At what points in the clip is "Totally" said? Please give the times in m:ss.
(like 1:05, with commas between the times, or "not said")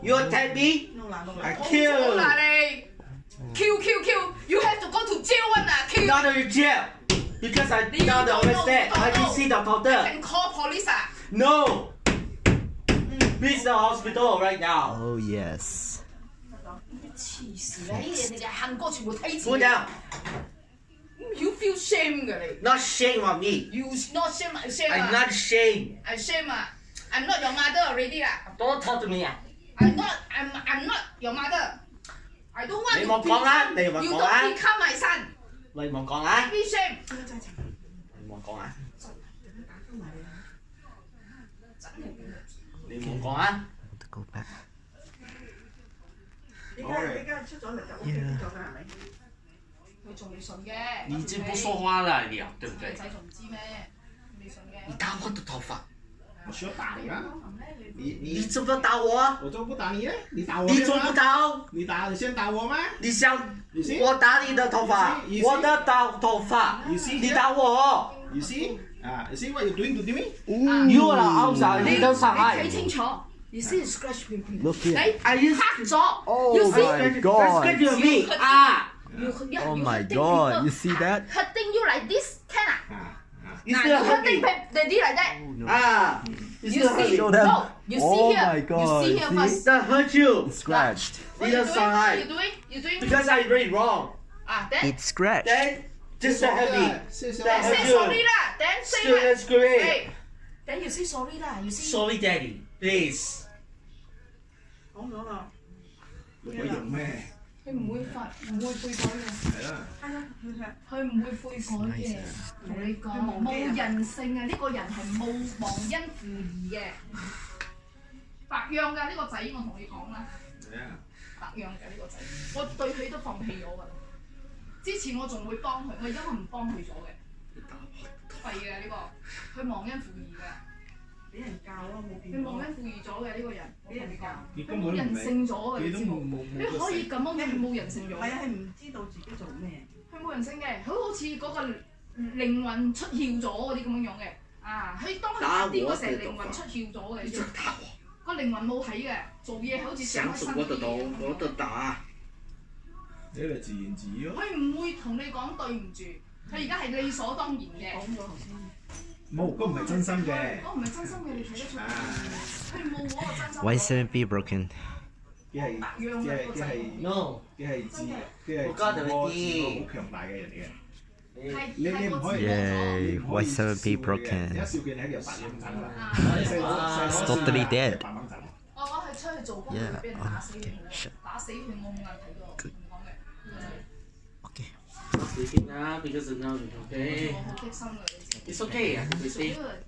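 2:57.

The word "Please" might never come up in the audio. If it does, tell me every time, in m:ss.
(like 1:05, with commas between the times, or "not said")
0:13, 1:42.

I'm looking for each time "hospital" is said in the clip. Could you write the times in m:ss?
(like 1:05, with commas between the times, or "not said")
0:13.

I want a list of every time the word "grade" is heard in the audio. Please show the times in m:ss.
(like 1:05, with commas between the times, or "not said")
1:39.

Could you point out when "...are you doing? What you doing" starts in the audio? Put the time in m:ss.
1:31.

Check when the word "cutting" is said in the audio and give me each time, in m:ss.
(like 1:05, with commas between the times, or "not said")
1:24.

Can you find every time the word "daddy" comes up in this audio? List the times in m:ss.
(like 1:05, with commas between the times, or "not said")
1:24, 1:42.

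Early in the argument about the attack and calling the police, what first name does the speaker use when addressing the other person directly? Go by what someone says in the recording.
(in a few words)
Gary.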